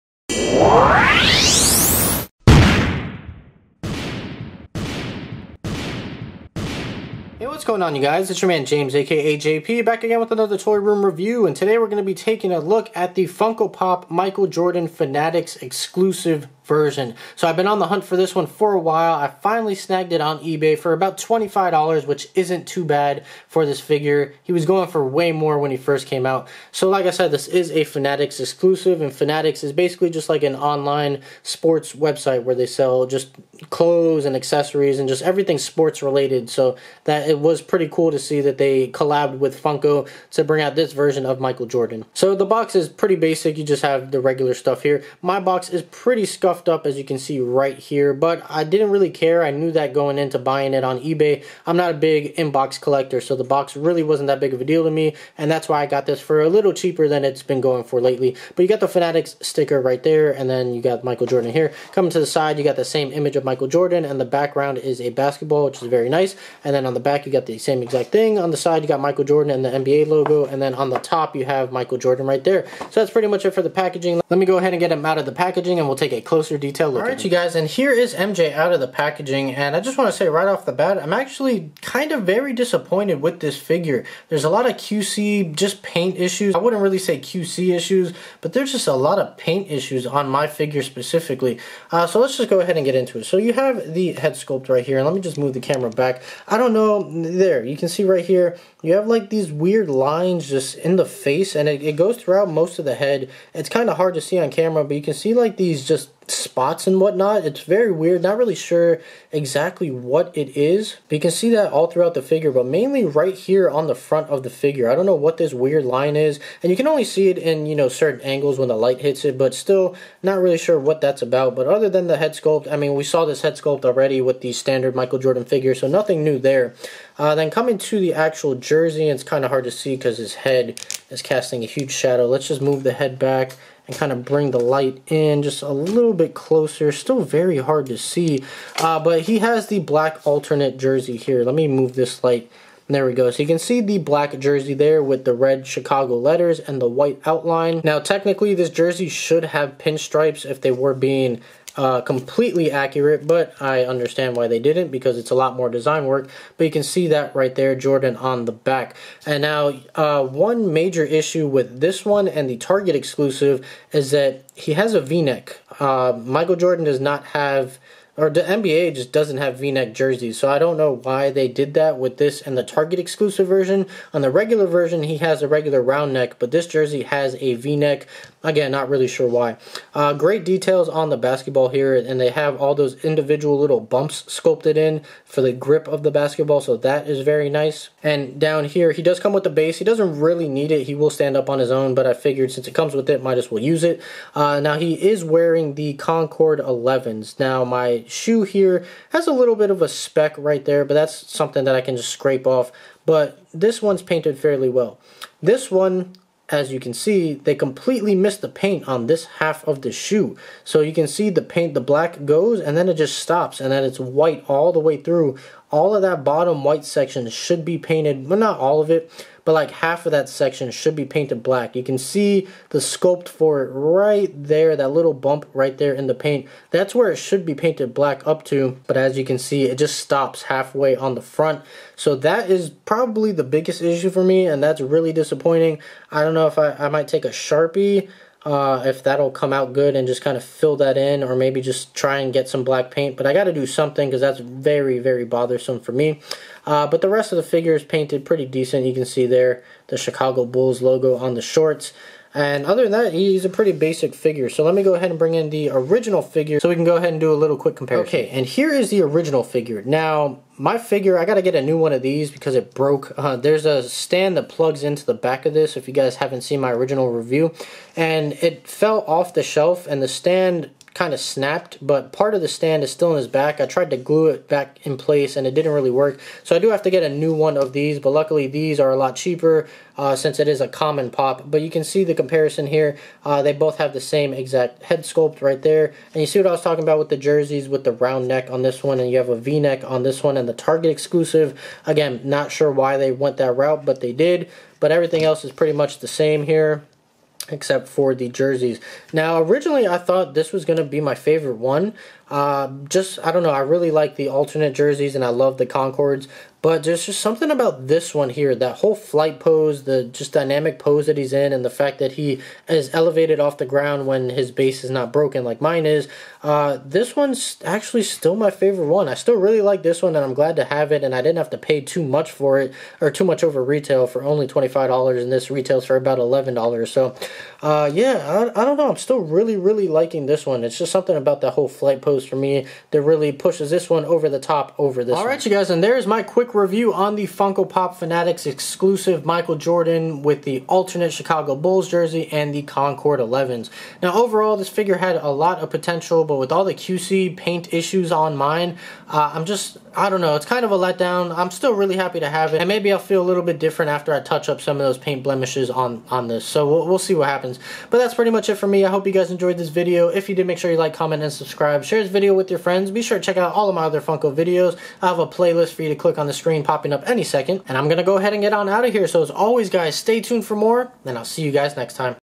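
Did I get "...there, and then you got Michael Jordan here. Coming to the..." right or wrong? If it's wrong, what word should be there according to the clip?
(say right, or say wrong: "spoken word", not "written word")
right.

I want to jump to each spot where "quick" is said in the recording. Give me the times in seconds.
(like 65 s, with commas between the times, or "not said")
257 s, 336 s.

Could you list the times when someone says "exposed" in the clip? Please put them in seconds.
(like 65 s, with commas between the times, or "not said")
not said.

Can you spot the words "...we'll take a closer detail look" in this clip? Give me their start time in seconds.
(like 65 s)
75 s.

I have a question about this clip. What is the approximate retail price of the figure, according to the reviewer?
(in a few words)
$11.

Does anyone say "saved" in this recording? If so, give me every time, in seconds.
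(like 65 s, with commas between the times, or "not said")
not said.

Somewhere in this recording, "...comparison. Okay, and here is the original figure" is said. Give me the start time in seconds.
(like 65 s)
257 s.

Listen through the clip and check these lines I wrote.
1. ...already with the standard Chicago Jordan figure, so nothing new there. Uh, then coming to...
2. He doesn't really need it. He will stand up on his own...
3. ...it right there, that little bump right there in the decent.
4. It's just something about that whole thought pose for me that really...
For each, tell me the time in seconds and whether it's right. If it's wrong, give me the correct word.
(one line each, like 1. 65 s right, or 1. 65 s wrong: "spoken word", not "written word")
1. 123 s wrong: "Michael", not "Chicago"
2. 189 s right
3. 223 s wrong: "paint", not "decent"
4. 330 s wrong: "flight", not "thought".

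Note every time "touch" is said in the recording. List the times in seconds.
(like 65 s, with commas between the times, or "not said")
354 s.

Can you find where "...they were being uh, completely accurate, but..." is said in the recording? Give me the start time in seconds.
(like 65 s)
150 s.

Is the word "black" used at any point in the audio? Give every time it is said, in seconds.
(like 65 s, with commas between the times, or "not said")
139 s, 143 s, 211 s, 221 s, 227 s, 242 s.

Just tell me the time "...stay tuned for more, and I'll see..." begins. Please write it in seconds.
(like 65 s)
369 s.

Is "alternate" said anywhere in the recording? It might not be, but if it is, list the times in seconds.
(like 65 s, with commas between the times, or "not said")
140 s, 304 s, 340 s.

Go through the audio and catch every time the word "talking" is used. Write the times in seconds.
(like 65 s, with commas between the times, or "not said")
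286 s.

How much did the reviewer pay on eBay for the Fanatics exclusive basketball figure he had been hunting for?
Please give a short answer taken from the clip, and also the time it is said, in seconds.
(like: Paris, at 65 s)
$25, at 21 s.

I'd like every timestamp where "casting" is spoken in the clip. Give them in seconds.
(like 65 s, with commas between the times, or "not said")
131 s.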